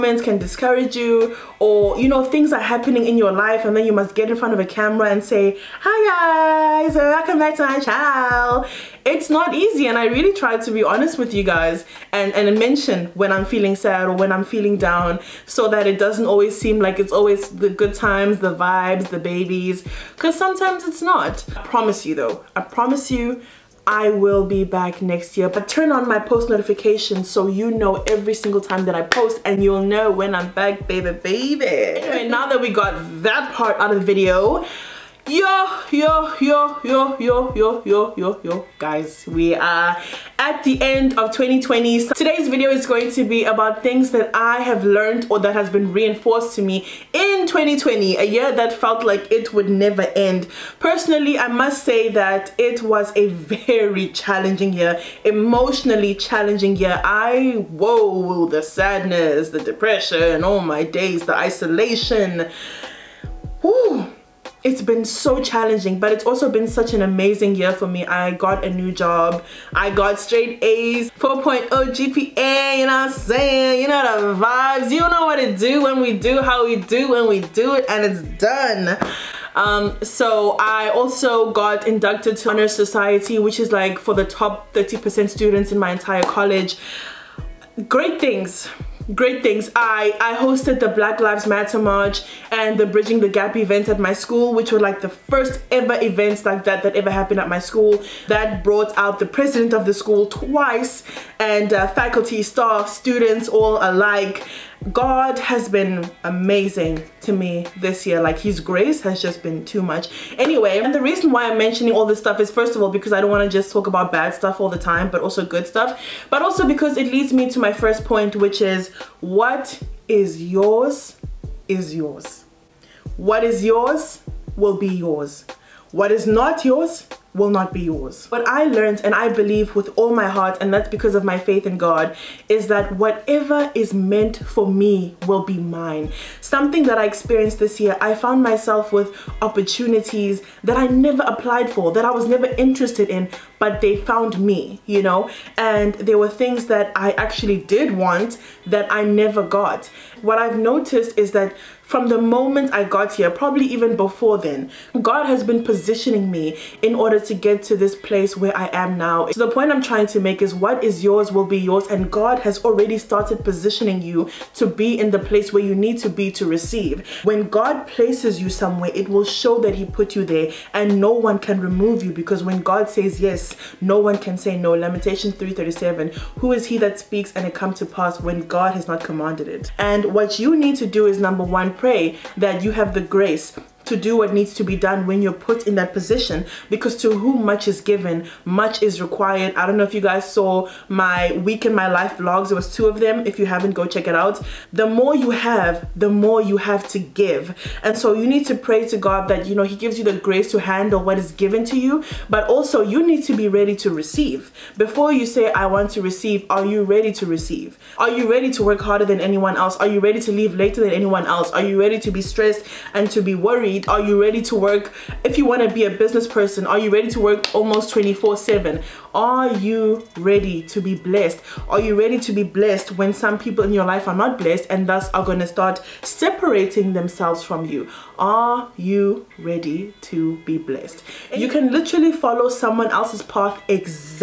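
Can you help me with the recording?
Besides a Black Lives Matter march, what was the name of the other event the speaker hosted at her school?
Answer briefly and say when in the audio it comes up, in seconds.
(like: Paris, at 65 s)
Bridging the Gap, at 92 s.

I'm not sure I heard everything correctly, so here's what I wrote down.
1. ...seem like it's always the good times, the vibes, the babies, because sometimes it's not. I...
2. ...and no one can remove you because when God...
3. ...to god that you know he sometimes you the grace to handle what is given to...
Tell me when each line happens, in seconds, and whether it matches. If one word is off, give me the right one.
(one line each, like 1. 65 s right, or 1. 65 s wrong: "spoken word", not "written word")
1. 16 s right
2. 170 s right
3. 198 s wrong: "gives", not "sometimes".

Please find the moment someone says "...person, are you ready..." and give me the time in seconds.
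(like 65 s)
216 s.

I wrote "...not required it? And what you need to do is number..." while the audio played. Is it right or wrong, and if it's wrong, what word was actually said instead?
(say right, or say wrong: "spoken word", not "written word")
wrong: "commanded", not "required".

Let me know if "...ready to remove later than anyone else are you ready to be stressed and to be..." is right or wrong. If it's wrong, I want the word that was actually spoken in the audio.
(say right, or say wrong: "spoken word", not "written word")
wrong: "leave", not "remove".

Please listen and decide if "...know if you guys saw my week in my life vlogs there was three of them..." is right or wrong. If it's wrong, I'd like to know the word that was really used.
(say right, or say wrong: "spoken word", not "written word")
wrong: "two", not "three".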